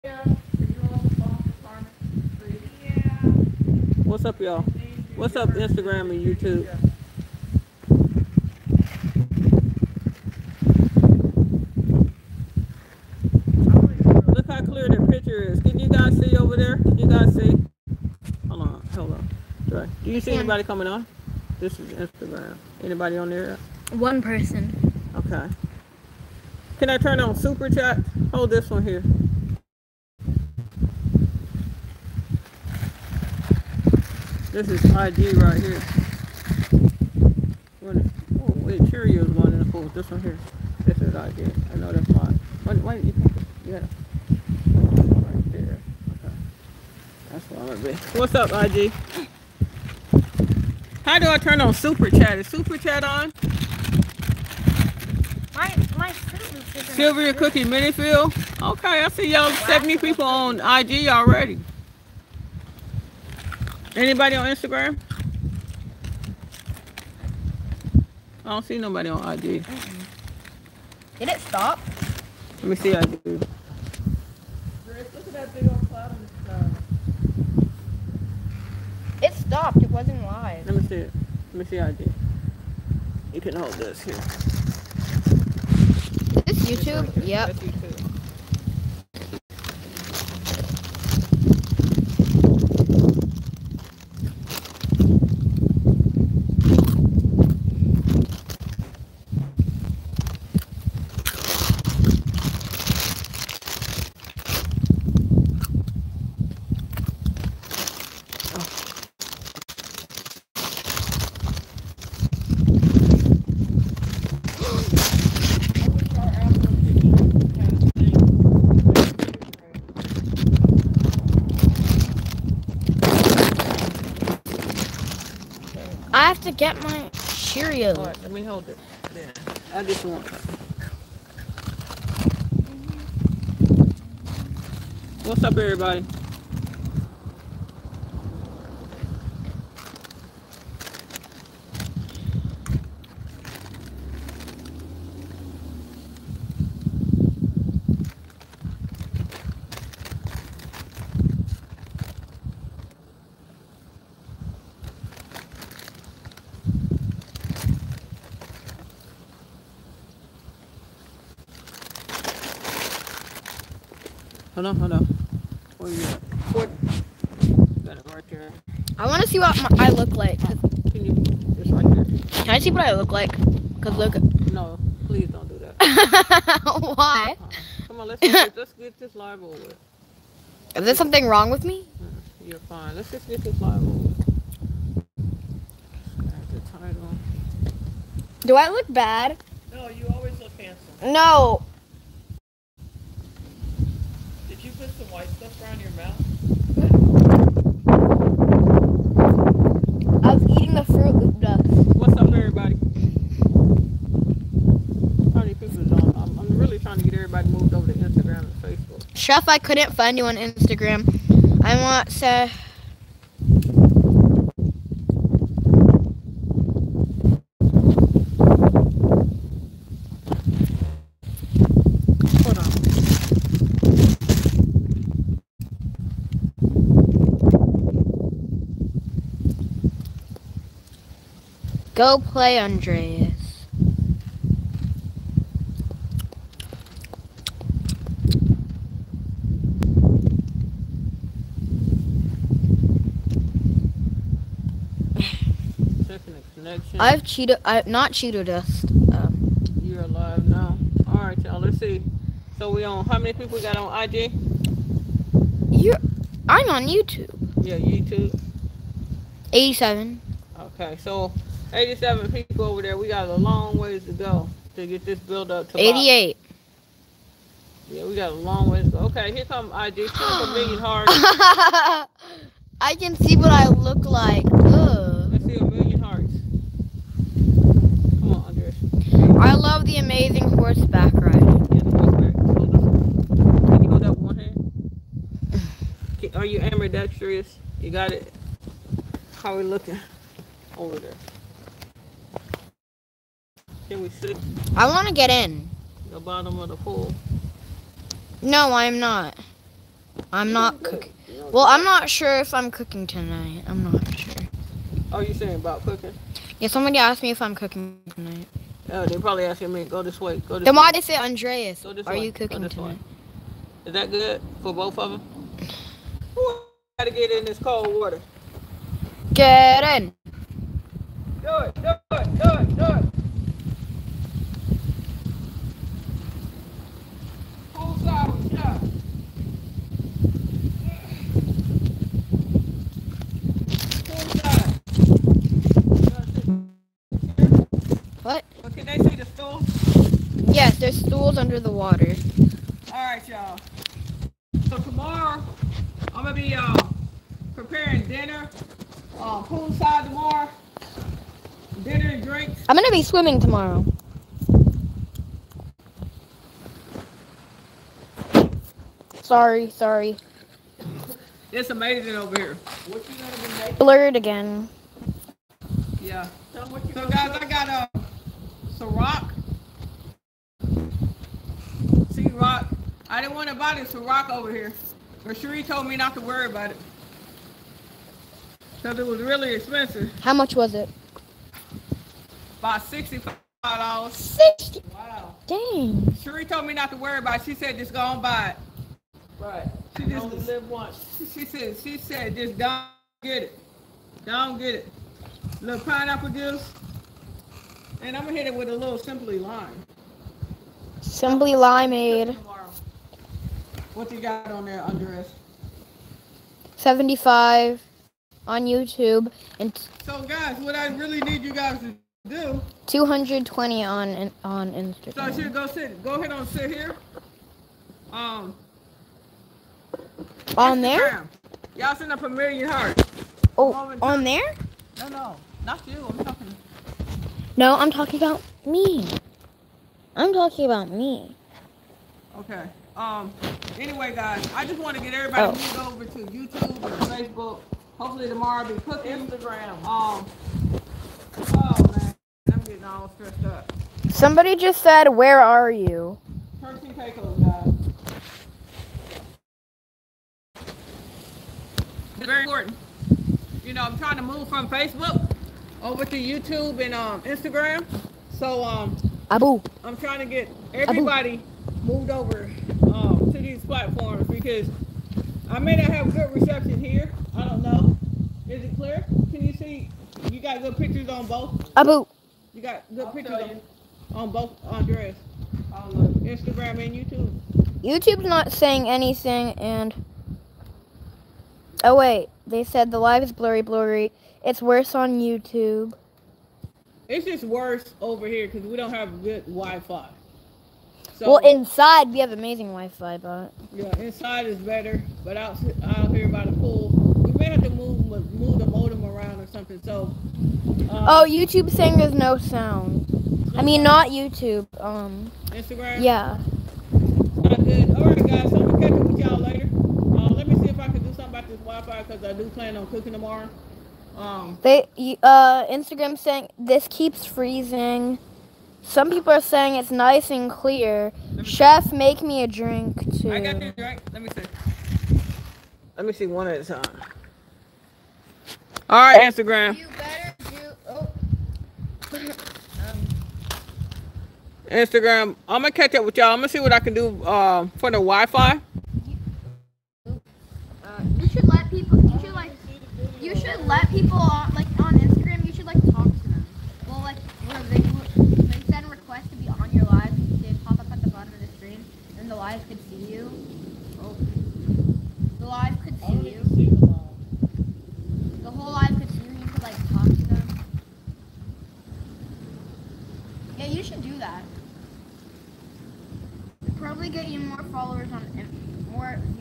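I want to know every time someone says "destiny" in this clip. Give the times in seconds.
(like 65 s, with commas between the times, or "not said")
not said.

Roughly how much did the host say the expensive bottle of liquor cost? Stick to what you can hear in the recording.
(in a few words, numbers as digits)
$65.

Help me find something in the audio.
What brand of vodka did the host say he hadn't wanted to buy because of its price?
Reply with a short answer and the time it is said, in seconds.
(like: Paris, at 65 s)
Ciroc, at 373 s.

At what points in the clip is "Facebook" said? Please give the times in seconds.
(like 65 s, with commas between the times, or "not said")
437 s, 454 s.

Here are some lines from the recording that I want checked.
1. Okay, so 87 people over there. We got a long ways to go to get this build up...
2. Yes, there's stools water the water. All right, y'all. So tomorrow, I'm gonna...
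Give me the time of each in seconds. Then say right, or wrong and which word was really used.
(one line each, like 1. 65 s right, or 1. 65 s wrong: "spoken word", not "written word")
1. 260 s right
2. 340 s wrong: "under", not "water".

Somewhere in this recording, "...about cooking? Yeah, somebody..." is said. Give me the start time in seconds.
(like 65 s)
305 s.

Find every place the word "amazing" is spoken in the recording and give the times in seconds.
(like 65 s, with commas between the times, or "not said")
279 s, 361 s, 492 s.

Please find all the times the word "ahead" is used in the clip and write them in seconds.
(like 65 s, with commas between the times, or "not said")
416 s.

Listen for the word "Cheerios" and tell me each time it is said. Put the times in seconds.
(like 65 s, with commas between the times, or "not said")
38 s, 127 s.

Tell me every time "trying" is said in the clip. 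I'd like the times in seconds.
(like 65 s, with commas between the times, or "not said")
453 s, 459 s.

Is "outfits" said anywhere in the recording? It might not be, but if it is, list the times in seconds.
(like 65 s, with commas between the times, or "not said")
not said.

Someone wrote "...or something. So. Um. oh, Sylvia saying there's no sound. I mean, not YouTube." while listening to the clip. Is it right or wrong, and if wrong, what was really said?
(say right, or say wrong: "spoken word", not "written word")
wrong: "YouTube", not "Sylvia".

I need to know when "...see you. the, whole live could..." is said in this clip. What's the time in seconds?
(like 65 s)
555 s.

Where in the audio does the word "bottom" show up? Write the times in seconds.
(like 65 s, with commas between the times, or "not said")
296 s, 551 s.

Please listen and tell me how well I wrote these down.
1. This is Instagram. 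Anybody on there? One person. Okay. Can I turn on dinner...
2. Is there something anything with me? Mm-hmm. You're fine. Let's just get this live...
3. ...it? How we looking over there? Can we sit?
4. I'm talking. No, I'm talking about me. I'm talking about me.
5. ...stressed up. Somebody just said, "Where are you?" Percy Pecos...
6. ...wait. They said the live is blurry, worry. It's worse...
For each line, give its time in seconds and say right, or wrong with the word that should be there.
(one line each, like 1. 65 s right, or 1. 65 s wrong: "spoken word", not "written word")
1. 21 s wrong: "super", not "dinner"
2. 180 s wrong: "wrong", not "anything"
3. 288 s right
4. 426 s right
5. 443 s right
6. 481 s wrong: "blurry", not "worry".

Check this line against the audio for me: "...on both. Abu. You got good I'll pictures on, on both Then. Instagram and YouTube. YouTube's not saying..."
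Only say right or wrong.
wrong.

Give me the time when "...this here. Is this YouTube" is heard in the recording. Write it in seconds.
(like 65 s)
83 s.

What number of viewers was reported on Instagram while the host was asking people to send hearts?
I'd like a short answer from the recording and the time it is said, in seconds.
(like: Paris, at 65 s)
220, at 412 s.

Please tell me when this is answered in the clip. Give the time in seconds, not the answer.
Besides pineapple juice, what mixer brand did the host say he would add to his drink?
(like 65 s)
401 s.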